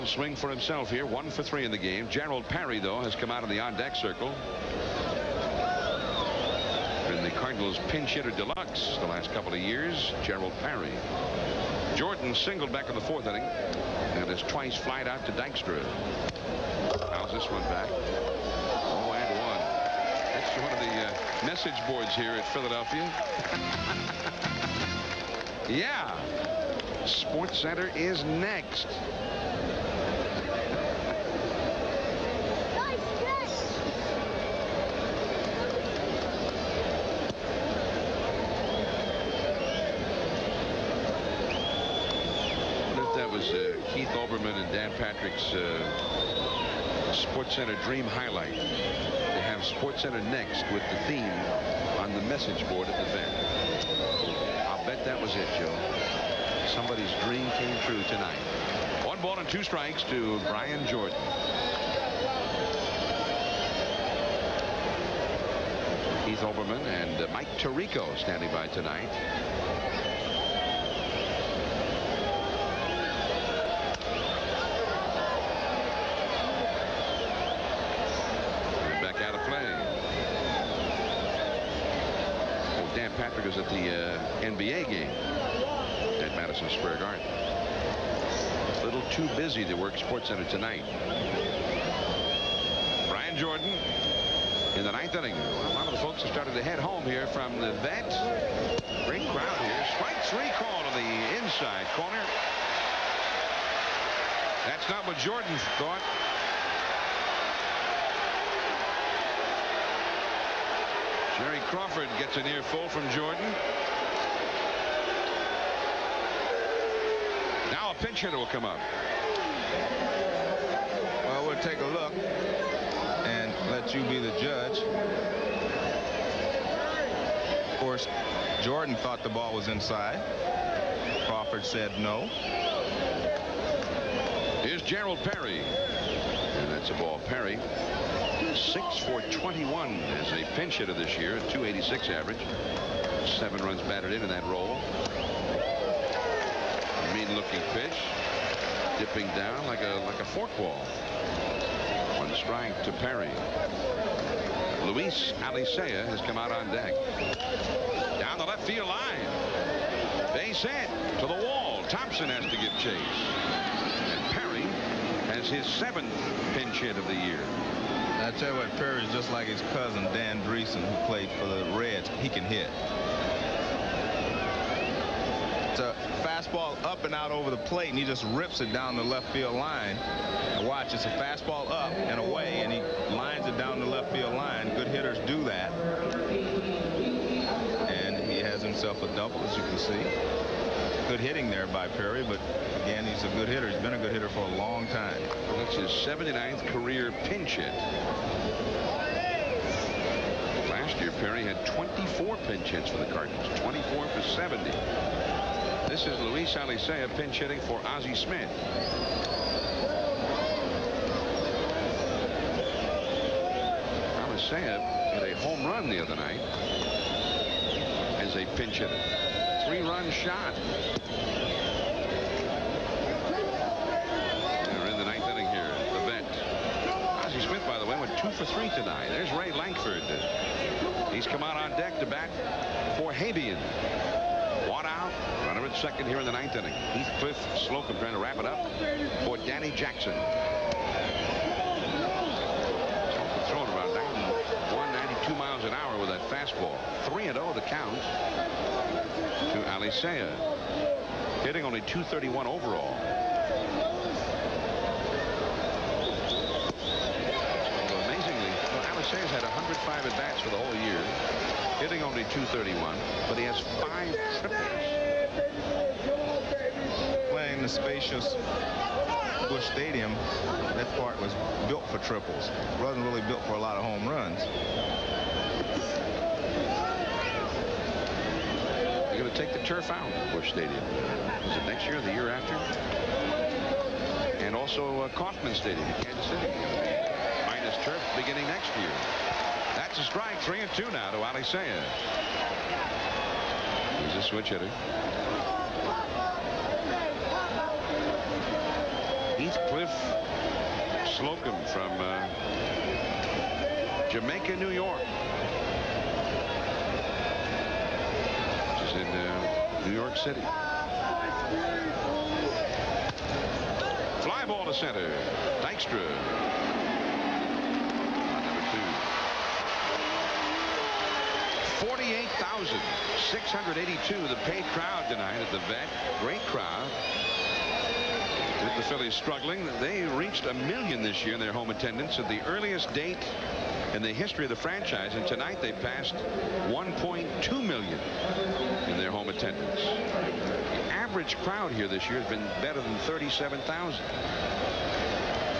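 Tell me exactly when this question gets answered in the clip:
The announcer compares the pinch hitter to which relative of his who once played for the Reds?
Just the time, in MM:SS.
02:50.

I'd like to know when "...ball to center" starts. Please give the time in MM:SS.
05:14.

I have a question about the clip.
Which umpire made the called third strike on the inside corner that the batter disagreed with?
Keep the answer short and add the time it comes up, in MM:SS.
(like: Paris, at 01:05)
Jerry Crawford, at 01:51.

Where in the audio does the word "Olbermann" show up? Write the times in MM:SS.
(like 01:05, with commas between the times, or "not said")
00:44, 01:06.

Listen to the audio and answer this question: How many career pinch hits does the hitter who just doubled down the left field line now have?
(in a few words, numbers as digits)
79.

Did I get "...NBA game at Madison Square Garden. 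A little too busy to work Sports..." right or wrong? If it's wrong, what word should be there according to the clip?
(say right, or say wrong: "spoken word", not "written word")
right.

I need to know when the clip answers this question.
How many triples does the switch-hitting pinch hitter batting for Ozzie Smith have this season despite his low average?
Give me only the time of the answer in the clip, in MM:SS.
04:23.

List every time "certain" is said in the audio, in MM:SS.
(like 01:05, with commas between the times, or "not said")
not said.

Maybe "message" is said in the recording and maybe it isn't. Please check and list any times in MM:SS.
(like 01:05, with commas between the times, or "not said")
00:21, 00:52.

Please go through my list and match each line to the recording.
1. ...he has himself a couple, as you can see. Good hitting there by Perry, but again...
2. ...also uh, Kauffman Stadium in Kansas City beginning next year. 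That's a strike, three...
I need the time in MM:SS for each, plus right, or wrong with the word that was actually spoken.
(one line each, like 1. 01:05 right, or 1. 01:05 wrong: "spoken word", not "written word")
1. 03:08 wrong: "double", not "couple"
2. 04:44 right.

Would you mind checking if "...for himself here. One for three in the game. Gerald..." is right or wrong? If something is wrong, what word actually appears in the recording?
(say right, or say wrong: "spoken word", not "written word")
right.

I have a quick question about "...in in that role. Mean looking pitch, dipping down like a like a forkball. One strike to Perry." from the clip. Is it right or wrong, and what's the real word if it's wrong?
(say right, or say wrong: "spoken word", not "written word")
right.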